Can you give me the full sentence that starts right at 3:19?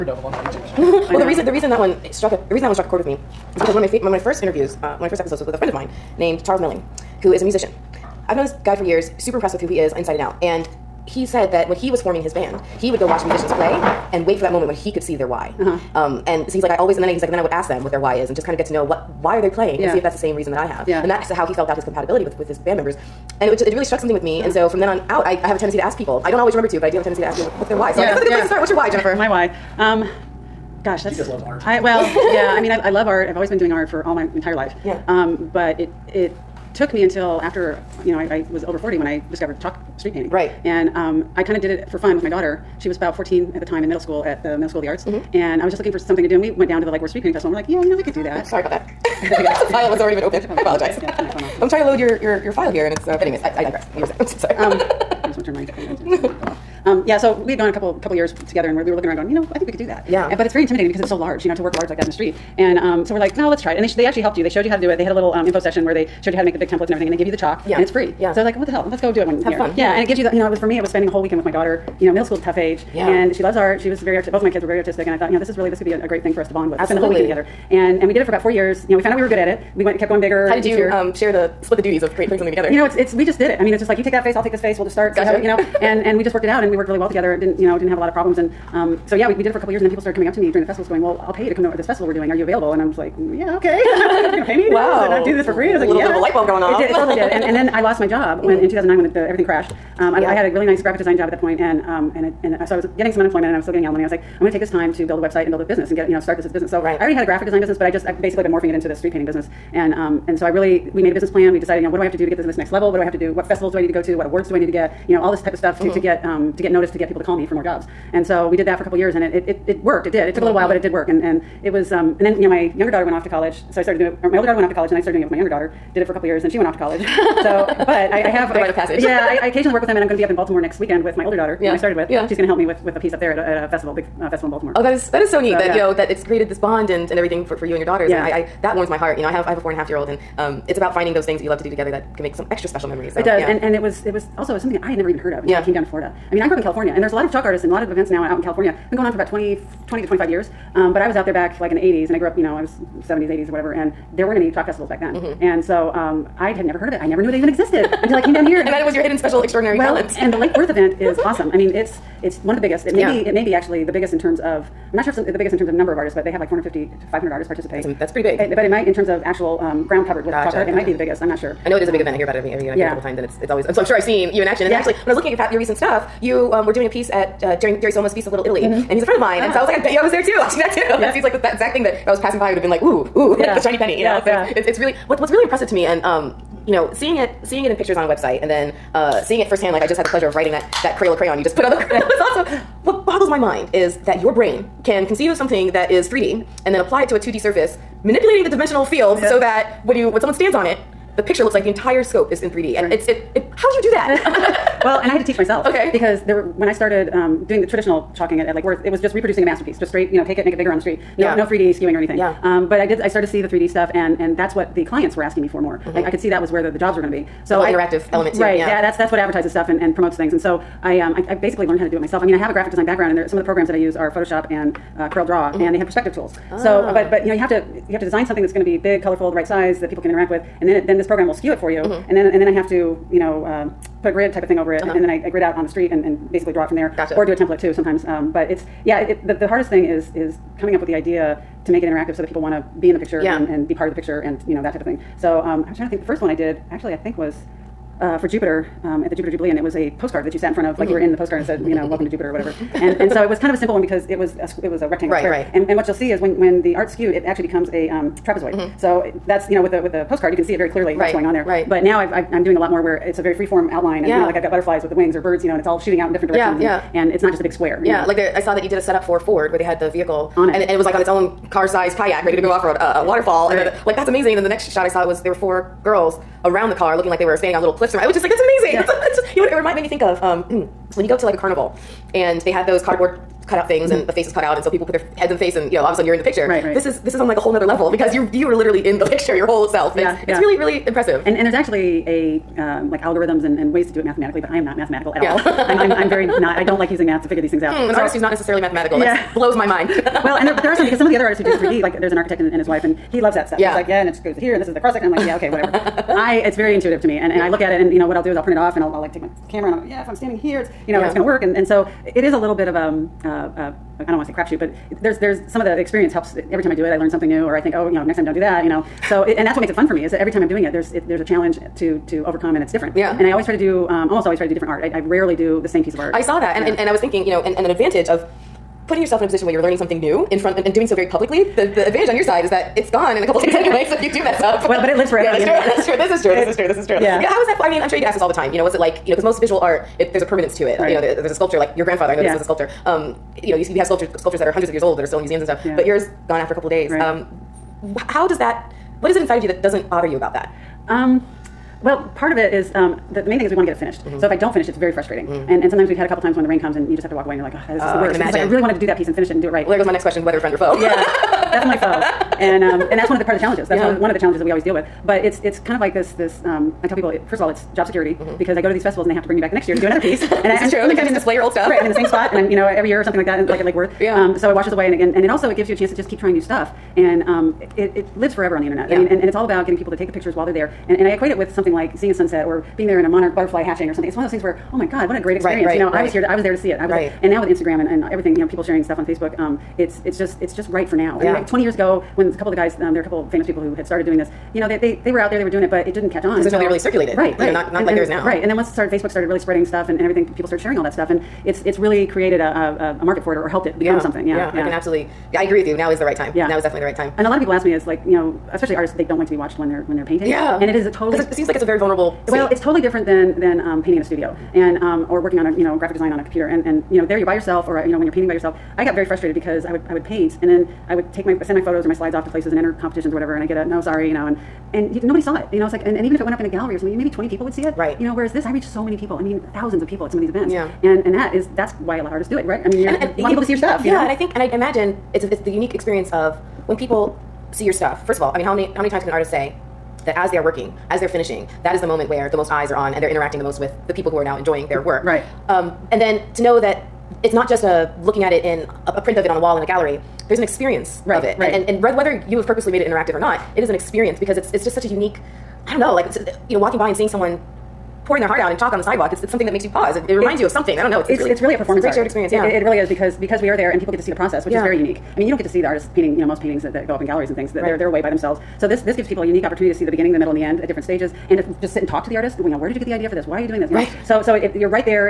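so that when you when someone stands on it, the picture looks like the entire scope is in 3D.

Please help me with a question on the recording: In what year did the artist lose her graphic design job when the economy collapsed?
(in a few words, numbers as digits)
2009.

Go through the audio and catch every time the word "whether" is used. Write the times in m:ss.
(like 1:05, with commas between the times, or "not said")
6:00, 7:31.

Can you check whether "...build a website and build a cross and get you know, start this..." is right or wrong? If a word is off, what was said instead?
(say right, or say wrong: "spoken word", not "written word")
wrong: "business", not "cross".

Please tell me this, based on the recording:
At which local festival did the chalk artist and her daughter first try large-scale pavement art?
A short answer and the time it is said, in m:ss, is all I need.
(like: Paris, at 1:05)
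Lake Worth Street Painting Festival, at 0:46.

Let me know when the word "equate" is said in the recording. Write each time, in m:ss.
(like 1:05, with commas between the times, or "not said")
6:21.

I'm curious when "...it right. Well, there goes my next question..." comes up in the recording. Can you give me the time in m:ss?
5:59.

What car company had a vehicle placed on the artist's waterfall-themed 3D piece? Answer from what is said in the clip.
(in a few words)
Ford.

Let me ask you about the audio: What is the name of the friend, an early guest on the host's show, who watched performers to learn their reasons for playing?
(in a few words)
Charles Milling.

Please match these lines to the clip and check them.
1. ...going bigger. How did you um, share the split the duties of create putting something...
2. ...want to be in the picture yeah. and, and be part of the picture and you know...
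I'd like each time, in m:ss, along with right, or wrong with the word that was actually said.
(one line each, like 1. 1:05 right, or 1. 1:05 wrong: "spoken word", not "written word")
1. 1:20 right
2. 4:02 right.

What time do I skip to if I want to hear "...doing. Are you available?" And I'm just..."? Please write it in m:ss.
1:32.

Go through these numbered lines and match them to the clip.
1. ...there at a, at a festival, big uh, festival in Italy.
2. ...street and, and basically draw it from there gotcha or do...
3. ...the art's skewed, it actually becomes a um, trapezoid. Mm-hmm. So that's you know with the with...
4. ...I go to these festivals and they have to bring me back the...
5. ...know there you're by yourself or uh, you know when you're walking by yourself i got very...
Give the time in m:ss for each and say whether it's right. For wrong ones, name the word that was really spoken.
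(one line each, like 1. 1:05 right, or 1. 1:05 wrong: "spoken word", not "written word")
1. 2:13 wrong: "Baltimore", not "Italy"
2. 3:55 right
3. 4:16 right
4. 6:08 right
5. 6:56 wrong: "painting", not "walking".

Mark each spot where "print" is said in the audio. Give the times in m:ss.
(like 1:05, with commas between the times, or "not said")
5:08, 7:28.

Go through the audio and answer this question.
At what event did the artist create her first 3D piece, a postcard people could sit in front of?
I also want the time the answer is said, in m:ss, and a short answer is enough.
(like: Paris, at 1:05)
Jupiter Jubilee, at 4:09.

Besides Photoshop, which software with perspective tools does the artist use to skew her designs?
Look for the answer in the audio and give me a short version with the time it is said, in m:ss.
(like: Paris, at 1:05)
Corel Draw, at 3:45.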